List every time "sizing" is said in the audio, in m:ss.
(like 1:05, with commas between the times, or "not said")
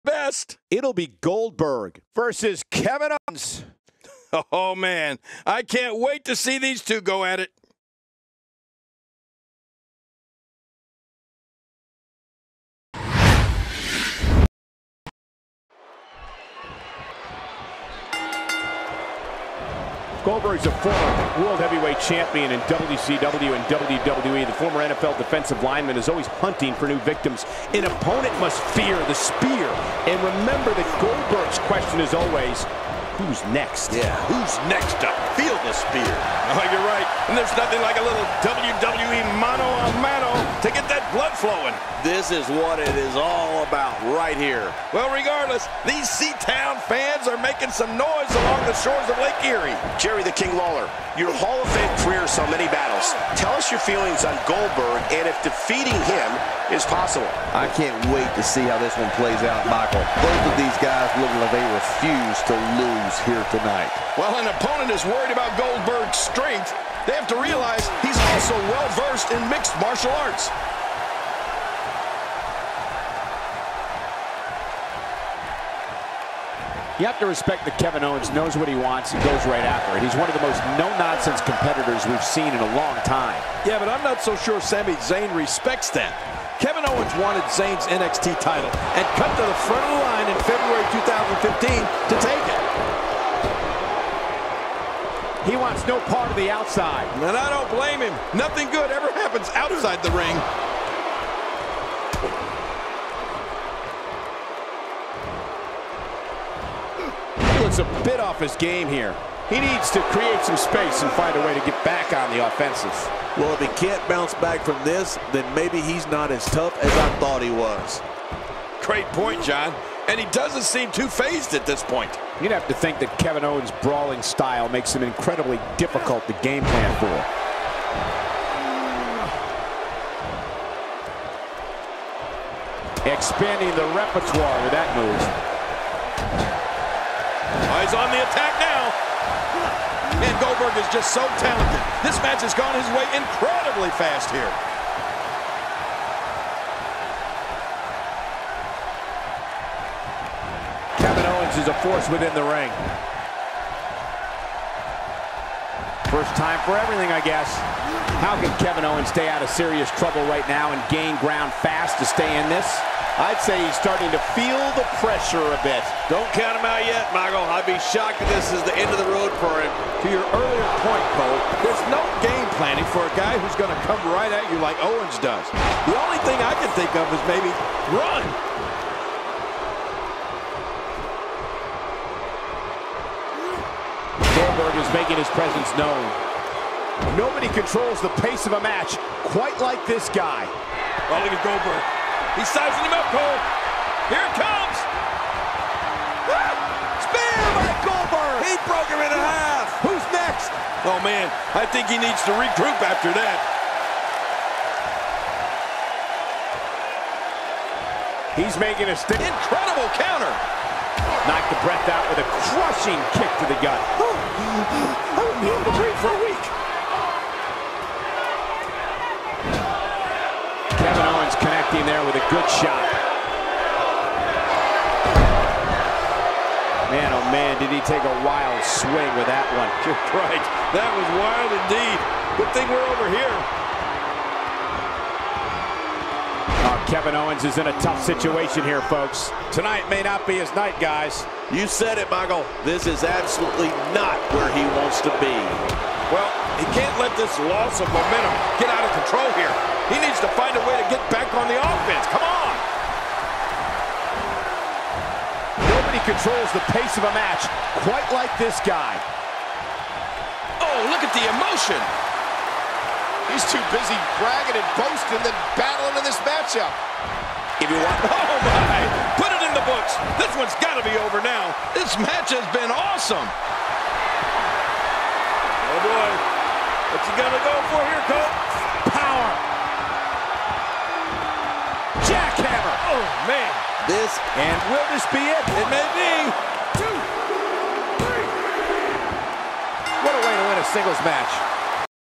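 3:12.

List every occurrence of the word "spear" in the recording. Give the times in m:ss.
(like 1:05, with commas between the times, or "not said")
0:29, 0:35, 3:17.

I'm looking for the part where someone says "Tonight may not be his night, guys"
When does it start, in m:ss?
3:59.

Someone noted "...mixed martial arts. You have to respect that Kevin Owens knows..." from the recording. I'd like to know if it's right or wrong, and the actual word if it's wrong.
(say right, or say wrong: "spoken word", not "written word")
right.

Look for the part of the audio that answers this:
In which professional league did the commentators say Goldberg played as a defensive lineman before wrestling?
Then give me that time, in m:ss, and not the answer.
0:24.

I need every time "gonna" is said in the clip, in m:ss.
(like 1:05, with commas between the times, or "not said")
4:37.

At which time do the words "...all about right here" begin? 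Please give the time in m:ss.
0:43.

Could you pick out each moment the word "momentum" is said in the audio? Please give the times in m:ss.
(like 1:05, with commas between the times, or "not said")
4:07.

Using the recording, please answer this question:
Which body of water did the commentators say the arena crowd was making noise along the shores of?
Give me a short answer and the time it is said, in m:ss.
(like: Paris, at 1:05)
Lake Erie, at 0:49.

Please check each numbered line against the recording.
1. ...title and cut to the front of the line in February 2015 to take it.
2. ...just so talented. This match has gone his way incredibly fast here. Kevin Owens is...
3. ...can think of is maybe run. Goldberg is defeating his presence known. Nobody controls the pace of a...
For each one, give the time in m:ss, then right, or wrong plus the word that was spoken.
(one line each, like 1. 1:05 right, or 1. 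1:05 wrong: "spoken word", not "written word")
1. 1:28 right
2. 2:20 right
3. 2:56 wrong: "making", not "defeating".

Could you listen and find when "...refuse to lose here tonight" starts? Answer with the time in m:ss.
1:01.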